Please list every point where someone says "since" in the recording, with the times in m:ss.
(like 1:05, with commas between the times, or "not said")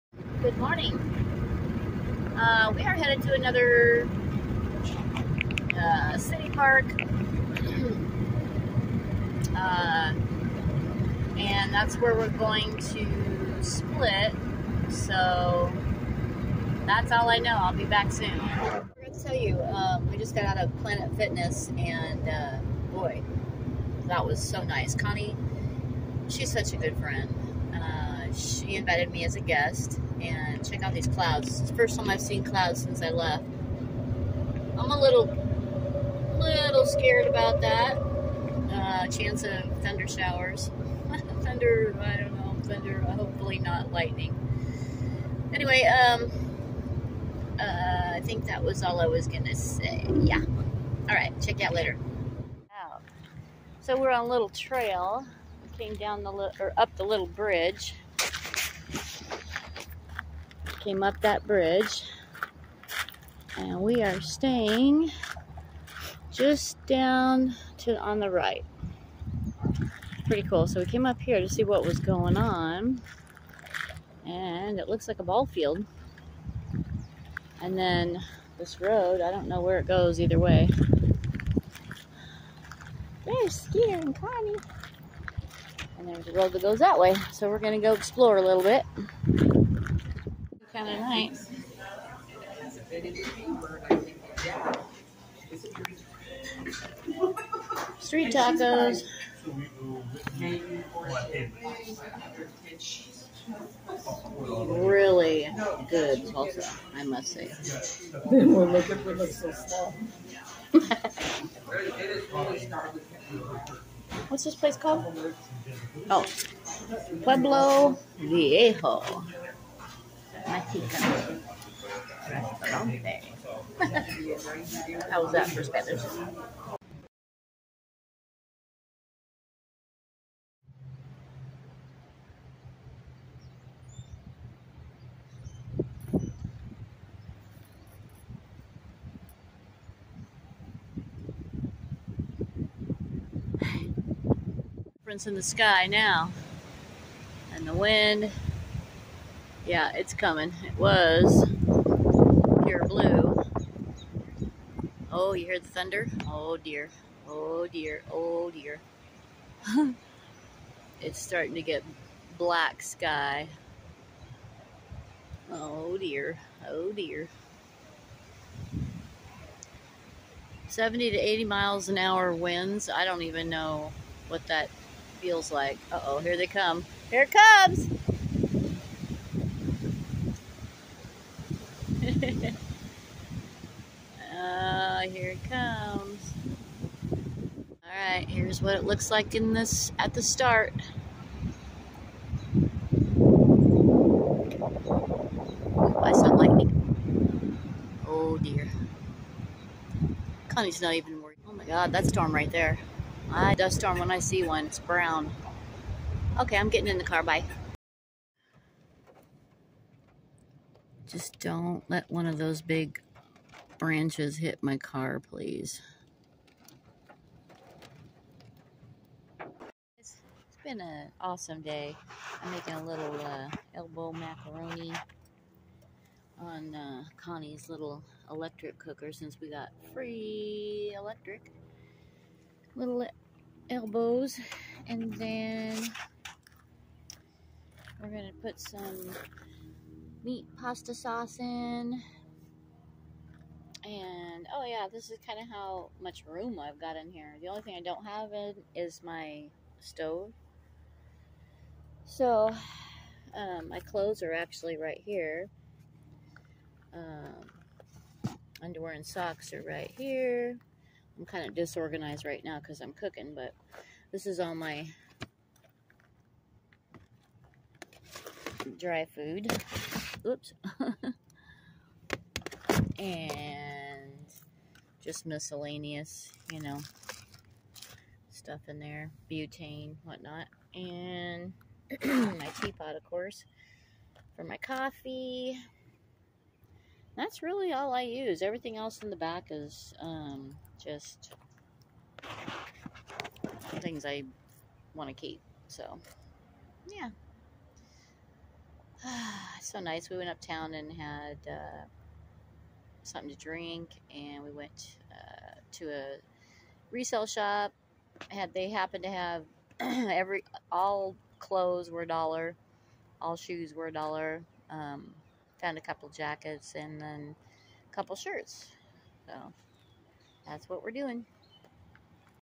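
0:32, 3:49.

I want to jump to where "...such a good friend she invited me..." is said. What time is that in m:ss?
0:26.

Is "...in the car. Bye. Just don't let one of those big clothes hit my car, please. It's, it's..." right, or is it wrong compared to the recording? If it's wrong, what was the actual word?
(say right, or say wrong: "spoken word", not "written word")
wrong: "branches", not "clothes".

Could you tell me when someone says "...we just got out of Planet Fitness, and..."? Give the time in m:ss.
0:20.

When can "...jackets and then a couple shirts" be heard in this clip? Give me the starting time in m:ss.
5:16.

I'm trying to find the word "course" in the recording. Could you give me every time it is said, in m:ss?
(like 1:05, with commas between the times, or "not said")
4:43.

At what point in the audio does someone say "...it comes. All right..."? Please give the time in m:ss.
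3:05.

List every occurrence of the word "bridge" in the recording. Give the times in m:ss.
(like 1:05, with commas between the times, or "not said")
0:57, 1:01.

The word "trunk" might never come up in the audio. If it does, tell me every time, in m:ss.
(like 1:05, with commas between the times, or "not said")
not said.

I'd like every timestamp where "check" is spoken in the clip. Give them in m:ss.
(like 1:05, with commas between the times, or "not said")
0:30, 0:51.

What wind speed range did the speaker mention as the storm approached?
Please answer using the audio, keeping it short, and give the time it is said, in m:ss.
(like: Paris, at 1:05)
70 to 80 miles an hour, at 2:50.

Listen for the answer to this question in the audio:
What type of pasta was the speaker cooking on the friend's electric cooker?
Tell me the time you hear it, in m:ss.
3:43.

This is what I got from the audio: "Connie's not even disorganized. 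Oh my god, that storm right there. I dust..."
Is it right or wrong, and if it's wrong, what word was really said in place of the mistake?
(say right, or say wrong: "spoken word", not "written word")
wrong: "worried", not "disorganized".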